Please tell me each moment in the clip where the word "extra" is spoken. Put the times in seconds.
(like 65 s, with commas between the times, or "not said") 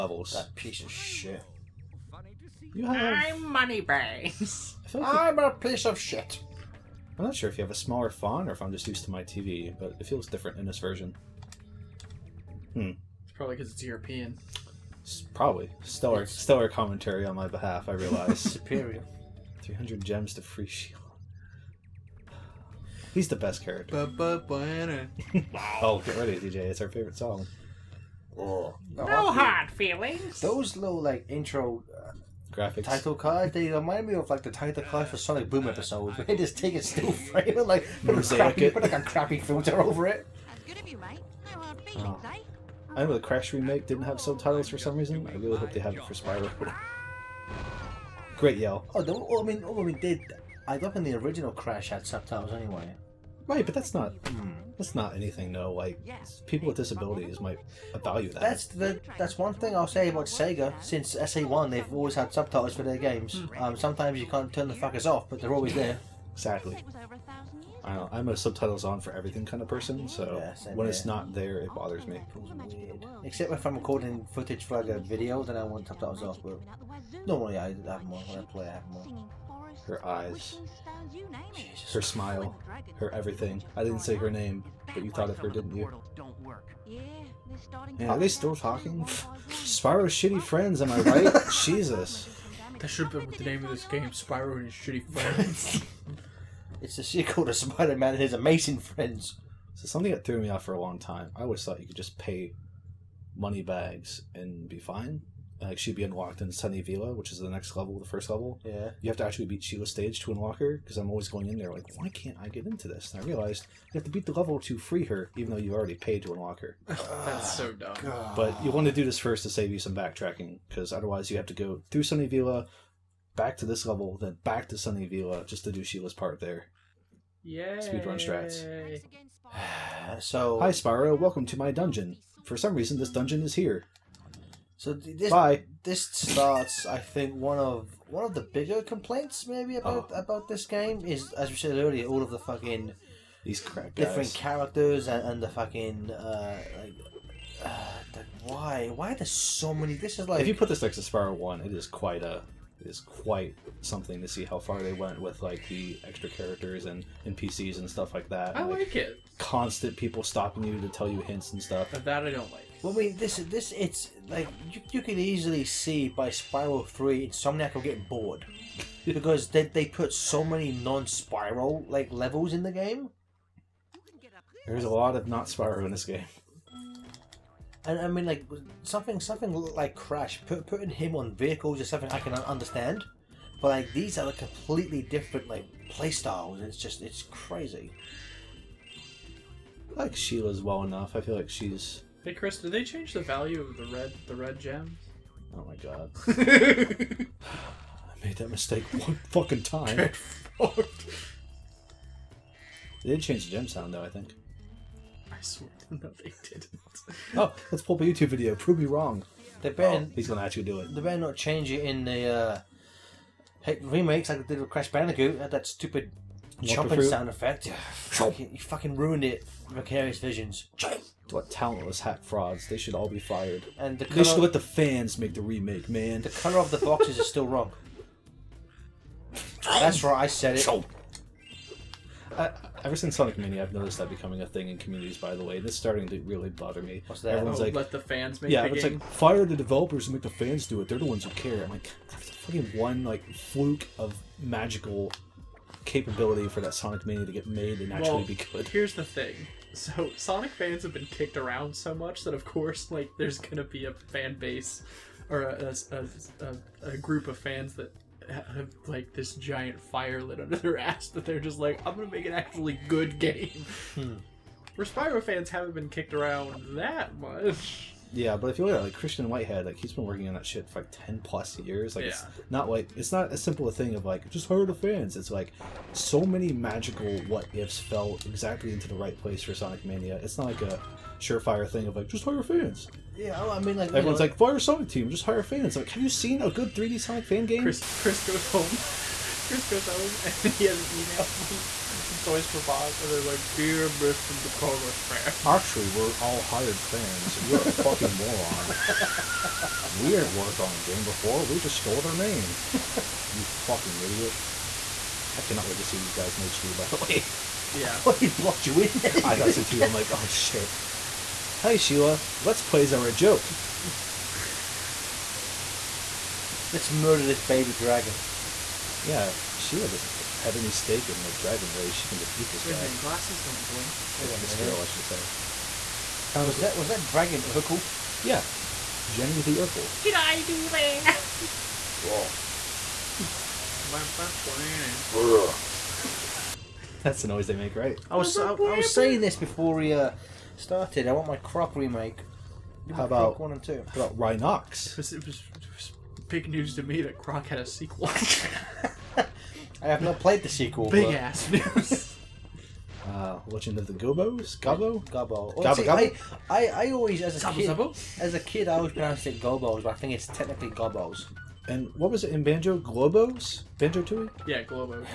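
156 s.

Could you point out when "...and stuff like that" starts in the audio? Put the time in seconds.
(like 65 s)
157 s.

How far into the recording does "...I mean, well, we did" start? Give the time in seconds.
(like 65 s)
49 s.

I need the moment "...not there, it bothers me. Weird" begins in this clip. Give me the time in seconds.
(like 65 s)
71 s.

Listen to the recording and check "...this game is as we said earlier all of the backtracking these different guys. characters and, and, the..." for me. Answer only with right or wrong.
wrong.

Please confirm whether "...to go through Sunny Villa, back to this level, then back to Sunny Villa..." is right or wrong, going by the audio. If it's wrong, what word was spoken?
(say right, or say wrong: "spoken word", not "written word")
right.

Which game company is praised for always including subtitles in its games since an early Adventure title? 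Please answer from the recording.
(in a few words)
Sega.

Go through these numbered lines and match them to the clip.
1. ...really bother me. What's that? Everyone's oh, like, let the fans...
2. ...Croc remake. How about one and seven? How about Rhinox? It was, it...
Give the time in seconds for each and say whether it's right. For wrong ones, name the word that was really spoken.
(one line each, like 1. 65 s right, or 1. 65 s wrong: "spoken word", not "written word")
1. 236 s right
2. 341 s wrong: "two", not "seven".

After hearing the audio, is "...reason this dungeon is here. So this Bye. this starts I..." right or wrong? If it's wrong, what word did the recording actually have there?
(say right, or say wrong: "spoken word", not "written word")
right.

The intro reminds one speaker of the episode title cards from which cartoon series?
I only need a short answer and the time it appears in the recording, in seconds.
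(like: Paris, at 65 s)
Sonic Boom, at 35 s.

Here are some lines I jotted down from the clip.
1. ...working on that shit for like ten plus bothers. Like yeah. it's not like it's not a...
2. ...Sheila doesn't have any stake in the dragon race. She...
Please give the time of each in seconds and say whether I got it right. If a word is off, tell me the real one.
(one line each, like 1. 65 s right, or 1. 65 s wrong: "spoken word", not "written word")
1. 270 s wrong: "years", not "bothers"
2. 319 s right.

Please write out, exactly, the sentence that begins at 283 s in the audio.
Yeah, oh, I mean, like everyone's like, fire Sonic team, just hire fans.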